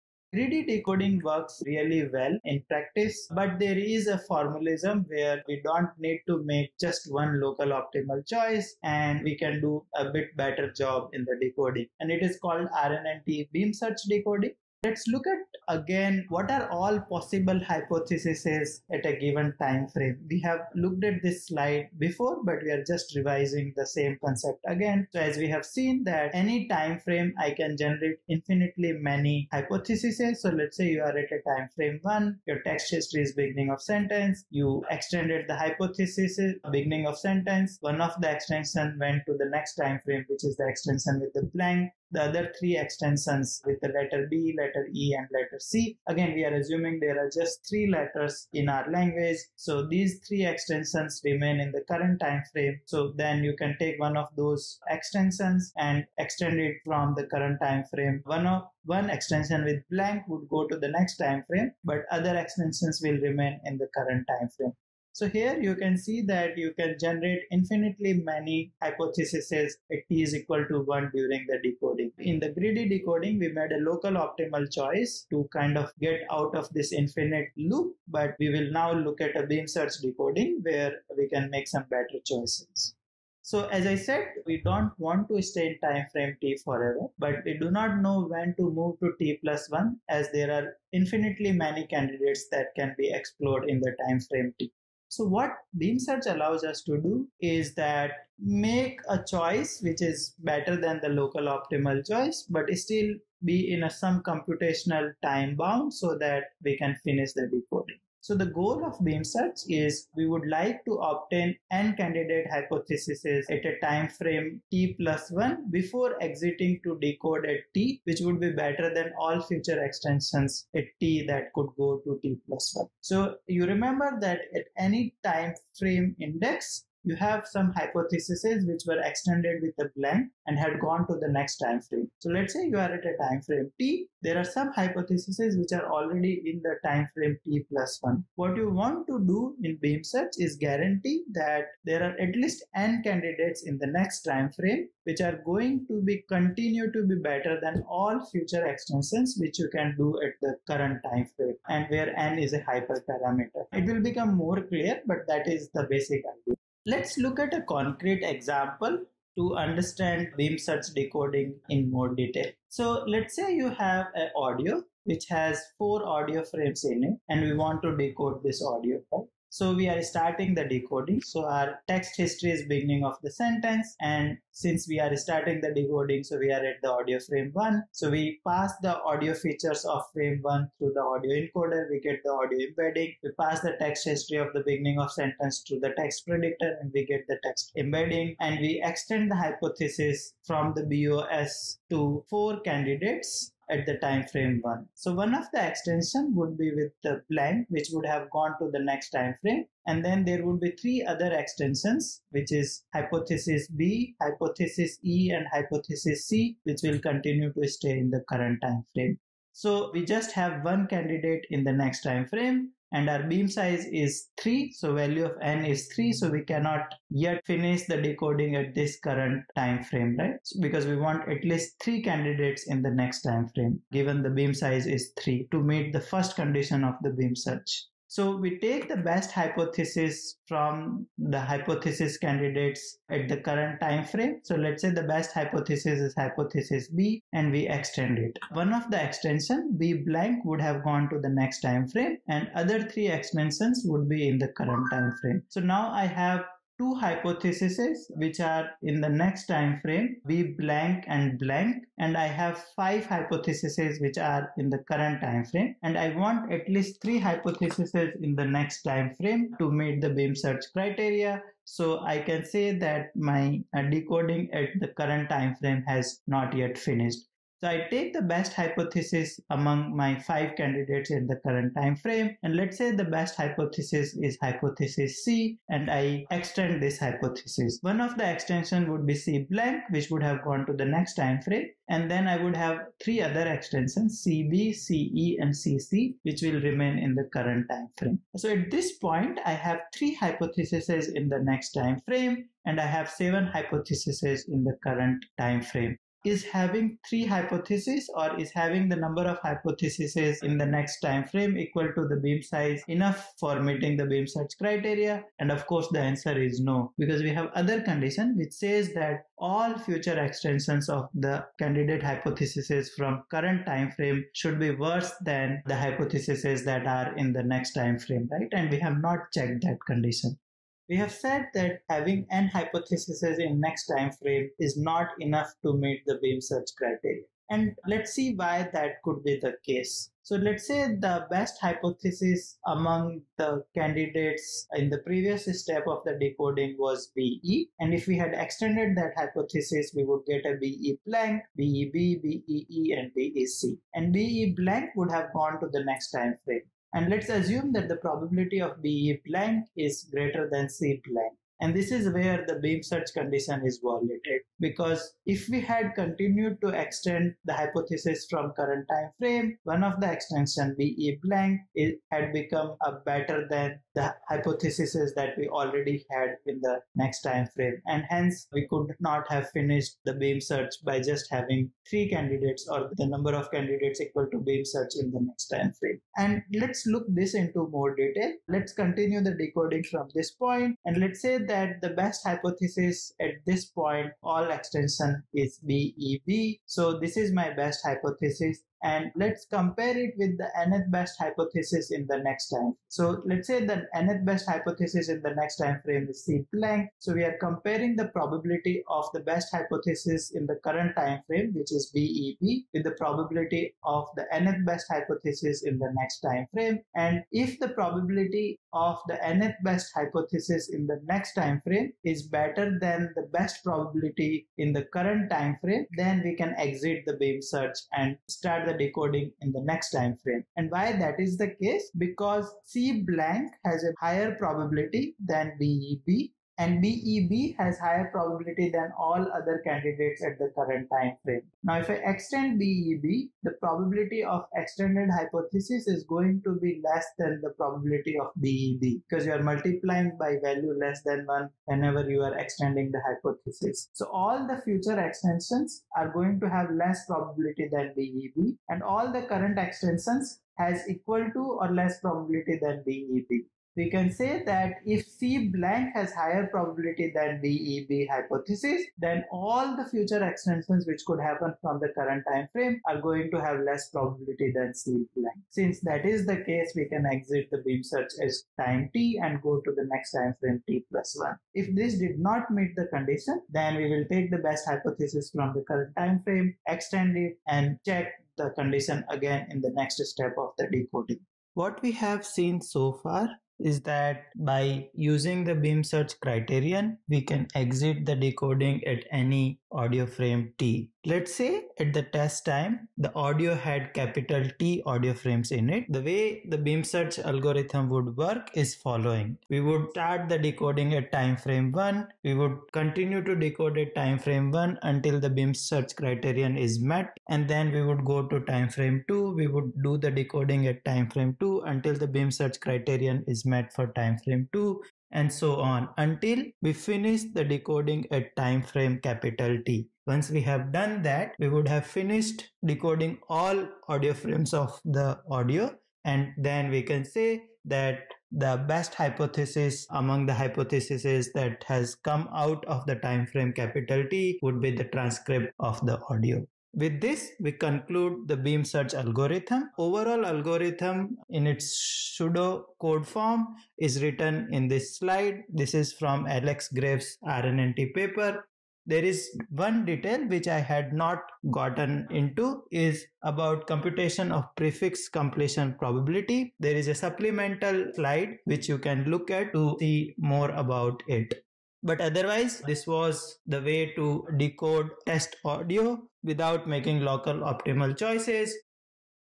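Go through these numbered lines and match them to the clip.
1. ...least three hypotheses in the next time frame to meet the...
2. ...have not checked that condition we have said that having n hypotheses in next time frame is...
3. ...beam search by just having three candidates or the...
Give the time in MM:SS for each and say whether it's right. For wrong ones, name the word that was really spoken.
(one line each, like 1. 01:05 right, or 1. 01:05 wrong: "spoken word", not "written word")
1. 04:16 right
2. 05:18 right
3. 06:10 right.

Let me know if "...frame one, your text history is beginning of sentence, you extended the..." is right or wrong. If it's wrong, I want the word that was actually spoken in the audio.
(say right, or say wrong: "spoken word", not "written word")
right.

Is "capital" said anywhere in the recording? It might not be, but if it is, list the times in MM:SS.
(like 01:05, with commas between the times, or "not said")
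08:13, 08:39, 08:53.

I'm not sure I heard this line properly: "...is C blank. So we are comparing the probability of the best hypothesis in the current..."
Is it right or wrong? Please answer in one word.
right.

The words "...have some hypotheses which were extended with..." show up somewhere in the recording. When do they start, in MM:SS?
02:07.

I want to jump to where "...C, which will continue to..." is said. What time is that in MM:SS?
03:26.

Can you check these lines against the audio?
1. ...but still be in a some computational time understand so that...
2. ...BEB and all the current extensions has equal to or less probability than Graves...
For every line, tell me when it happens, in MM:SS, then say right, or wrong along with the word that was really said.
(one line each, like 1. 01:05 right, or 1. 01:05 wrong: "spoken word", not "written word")
1. 01:42 wrong: "bound", not "understand"
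2. 07:27 wrong: "BEB", not "Graves".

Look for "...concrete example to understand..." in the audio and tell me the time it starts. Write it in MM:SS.
02:37.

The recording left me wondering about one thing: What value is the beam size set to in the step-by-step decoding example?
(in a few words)
3.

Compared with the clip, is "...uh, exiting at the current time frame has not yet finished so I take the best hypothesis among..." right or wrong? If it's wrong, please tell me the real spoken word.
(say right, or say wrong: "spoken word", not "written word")
wrong: "decoding", not "exiting".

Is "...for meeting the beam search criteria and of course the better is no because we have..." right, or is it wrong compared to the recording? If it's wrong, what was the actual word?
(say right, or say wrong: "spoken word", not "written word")
wrong: "answer", not "better".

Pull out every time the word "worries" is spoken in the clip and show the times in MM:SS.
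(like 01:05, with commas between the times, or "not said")
not said.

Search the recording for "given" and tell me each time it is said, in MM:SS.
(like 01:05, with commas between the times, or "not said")
00:19, 03:43.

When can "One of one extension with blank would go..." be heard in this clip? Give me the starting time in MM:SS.
00:58.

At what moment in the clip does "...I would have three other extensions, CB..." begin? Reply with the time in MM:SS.
04:42.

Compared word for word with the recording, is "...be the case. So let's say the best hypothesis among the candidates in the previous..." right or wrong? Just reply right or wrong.
right.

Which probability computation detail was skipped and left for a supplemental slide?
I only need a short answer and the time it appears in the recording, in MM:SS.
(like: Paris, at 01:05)
prefix completion probability, at 09:14.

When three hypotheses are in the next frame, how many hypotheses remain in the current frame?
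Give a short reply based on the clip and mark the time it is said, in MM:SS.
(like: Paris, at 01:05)
7, at 04:53.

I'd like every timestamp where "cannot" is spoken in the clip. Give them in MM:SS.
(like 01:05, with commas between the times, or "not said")
03:36.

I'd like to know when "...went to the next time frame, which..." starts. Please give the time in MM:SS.
00:38.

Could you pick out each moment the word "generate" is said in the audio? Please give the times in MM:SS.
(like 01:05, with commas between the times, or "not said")
00:27, 01:06.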